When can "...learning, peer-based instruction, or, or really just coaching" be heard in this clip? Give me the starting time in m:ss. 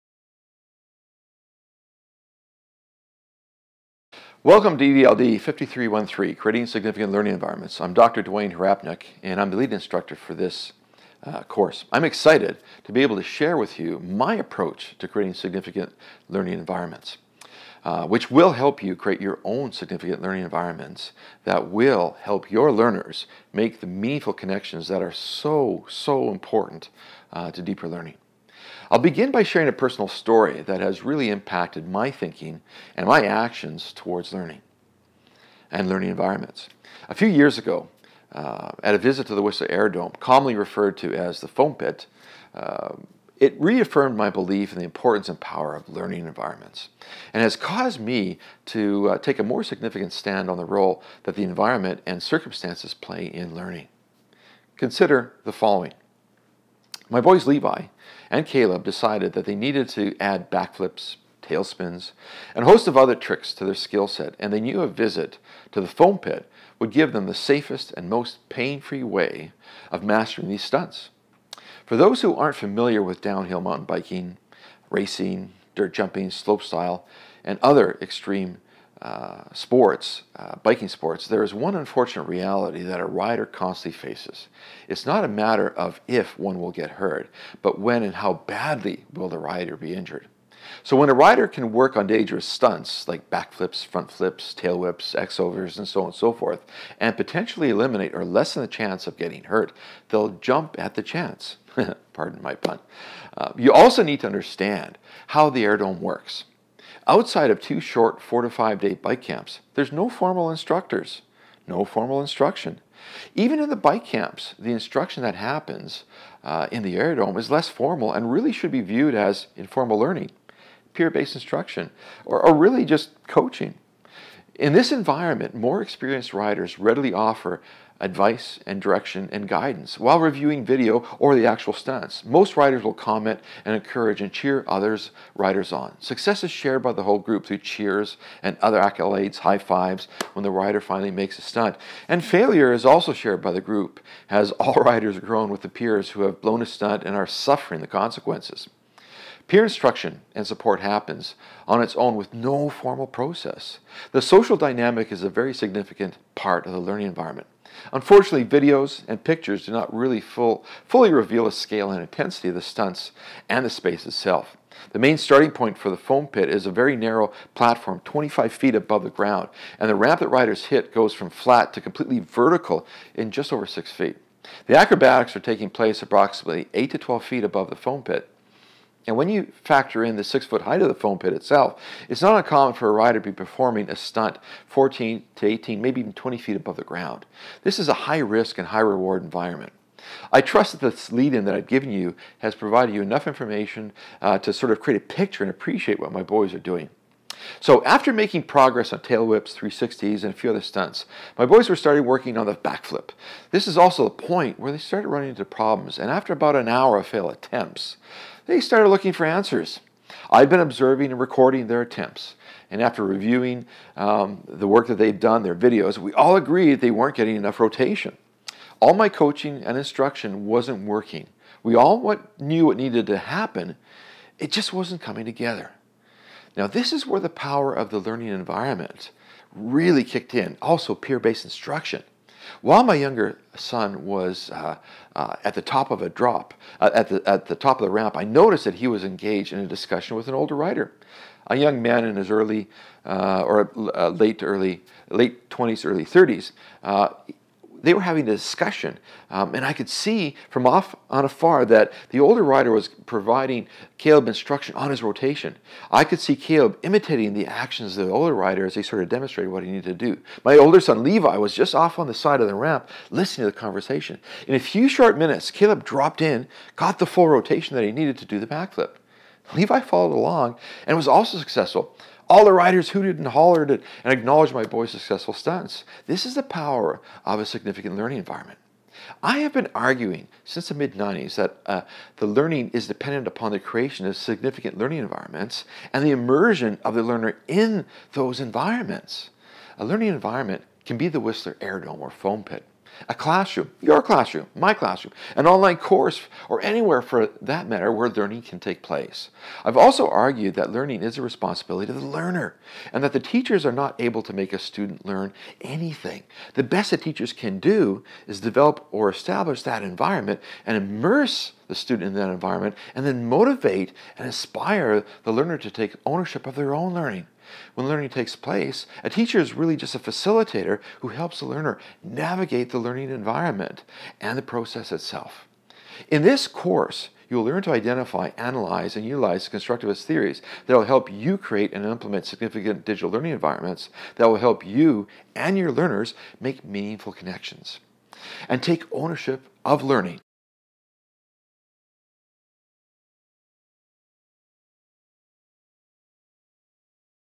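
1:59.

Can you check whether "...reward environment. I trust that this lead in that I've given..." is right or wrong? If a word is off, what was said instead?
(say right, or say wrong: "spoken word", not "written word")
right.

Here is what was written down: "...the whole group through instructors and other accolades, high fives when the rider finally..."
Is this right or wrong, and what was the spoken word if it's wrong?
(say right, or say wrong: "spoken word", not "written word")
wrong: "cheers", not "instructors".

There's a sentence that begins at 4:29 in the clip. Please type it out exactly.
Levi followed along and was also successful.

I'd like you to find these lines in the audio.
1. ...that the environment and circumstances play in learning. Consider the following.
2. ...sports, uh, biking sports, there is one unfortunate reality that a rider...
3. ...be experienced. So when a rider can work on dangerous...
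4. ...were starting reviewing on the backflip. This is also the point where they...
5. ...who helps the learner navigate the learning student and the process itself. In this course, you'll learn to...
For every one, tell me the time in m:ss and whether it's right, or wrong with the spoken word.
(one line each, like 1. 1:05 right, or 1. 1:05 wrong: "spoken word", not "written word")
1. 0:51 right
2. 1:19 right
3. 1:29 wrong: "injured", not "experienced"
4. 3:21 wrong: "working", not "reviewing"
5. 5:20 wrong: "environment", not "student".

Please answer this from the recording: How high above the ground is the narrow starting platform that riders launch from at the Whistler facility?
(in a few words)
25 feet.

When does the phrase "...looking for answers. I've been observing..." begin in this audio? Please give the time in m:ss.
3:28.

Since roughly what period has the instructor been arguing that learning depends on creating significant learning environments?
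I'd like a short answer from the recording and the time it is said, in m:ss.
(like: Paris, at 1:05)
the mid 90s, at 4:40.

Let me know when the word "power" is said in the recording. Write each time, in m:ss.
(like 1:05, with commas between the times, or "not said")
0:45, 3:47, 4:36.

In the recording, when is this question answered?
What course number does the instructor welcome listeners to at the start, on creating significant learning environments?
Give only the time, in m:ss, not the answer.
0:04.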